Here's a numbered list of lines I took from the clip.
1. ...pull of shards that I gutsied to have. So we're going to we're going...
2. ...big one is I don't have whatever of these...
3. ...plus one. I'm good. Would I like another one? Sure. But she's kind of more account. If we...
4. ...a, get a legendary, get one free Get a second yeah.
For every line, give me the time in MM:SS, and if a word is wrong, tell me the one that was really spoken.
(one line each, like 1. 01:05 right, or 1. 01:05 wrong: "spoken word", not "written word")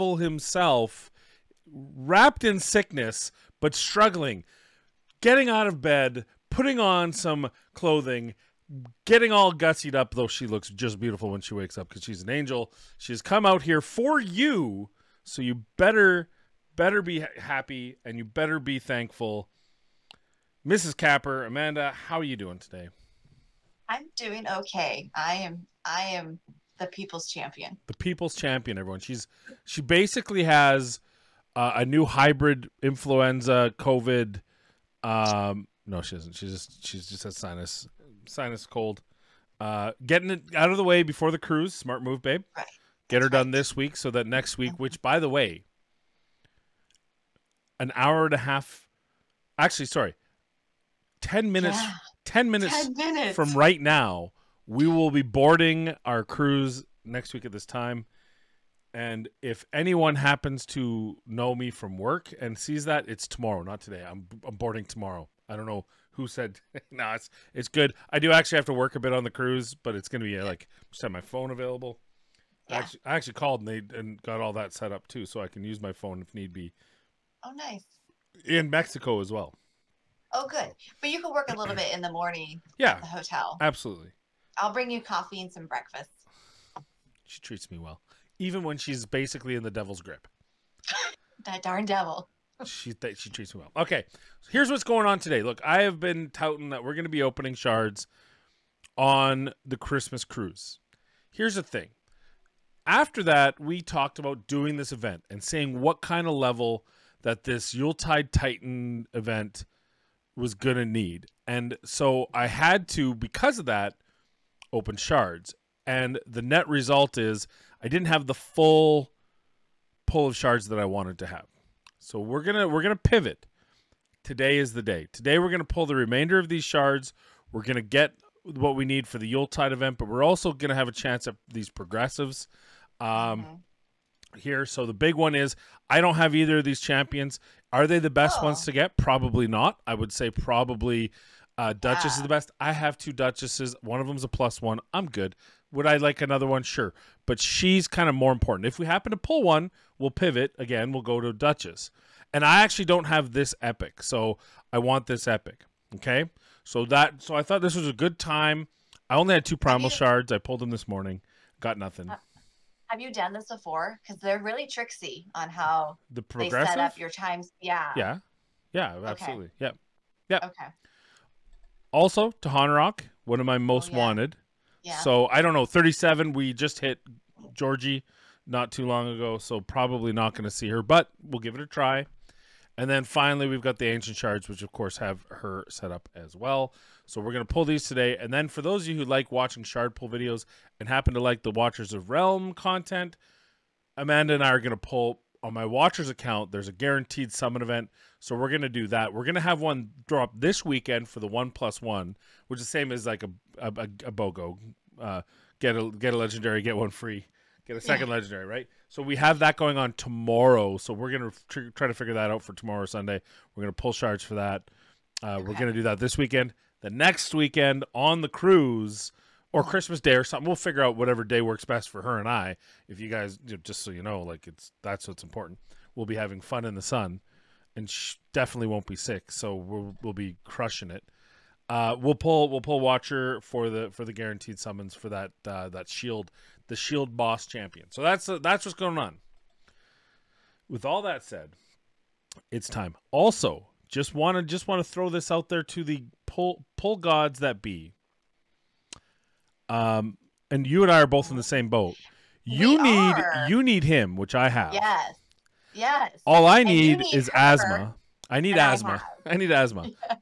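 1. 02:00 wrong: "wanted", not "gutsied"
2. 02:14 wrong: "either", not "whatever"
3. 02:24 wrong: "important", not "account"
4. 03:25 right.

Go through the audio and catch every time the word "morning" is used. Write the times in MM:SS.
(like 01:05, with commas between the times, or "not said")
01:22, 02:40.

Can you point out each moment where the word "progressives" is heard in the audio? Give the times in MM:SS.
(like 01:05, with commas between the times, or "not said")
02:11, 02:46.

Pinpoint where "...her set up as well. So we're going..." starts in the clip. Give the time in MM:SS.
03:05.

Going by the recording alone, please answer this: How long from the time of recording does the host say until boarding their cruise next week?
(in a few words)
10 minutes.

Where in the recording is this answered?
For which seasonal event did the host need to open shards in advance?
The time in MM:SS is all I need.
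01:47.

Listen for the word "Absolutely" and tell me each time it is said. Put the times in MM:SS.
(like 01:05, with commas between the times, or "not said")
01:23, 02:49.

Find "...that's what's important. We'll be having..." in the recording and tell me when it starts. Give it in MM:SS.
03:44.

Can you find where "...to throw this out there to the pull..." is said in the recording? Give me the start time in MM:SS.
04:04.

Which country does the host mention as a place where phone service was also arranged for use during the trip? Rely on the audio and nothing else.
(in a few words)
Mexico.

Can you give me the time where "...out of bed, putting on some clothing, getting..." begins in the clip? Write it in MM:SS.
00:05.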